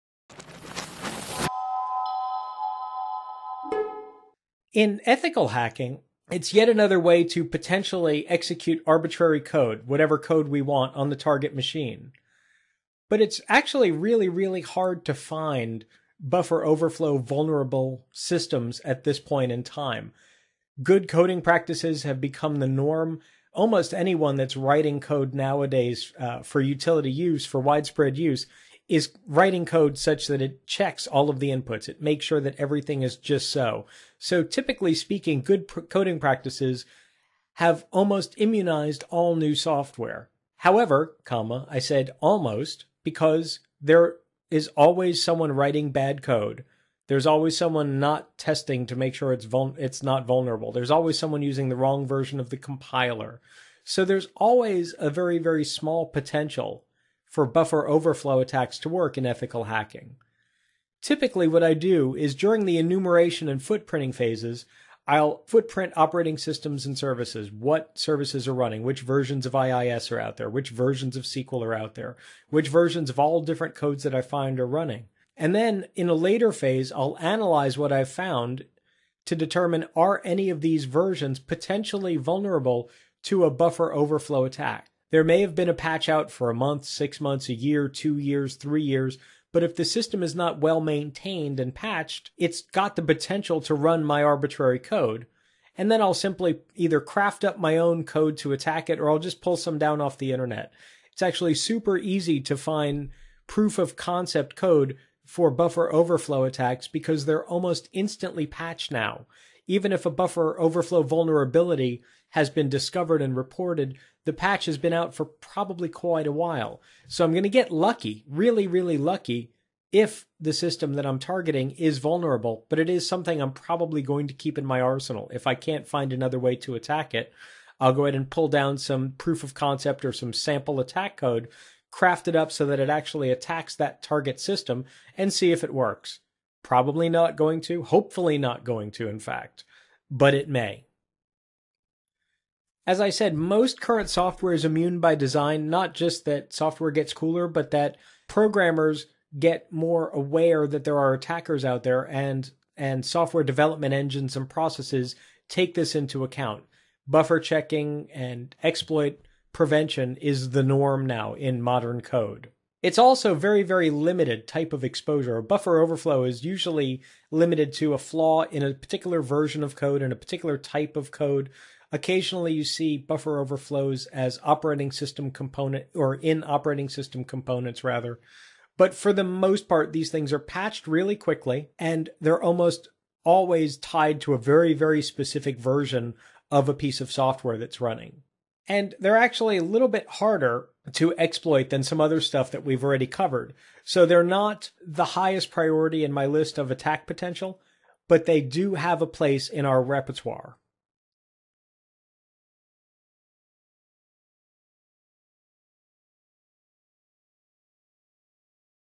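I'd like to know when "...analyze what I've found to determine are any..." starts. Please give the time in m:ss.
1:17.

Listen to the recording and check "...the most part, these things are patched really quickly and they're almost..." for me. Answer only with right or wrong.
right.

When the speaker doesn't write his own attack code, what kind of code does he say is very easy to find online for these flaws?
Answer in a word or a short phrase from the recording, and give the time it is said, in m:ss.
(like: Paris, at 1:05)
Proof of concept code, at 1:43.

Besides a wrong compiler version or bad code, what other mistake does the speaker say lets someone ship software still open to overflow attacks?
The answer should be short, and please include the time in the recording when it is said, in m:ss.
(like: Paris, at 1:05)
Not testing, at 0:47.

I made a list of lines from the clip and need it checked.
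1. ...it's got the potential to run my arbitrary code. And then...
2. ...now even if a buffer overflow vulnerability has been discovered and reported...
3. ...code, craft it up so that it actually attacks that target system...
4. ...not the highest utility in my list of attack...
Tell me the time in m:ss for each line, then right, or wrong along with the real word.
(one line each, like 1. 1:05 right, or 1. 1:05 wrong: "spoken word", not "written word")
1. 1:32 right
2. 1:48 right
3. 2:11 right
4. 3:14 wrong: "priority", not "utility".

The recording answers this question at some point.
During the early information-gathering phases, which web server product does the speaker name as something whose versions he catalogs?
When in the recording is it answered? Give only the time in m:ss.
1:09.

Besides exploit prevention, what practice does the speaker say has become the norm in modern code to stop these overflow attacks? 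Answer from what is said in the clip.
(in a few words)
Buffer checking.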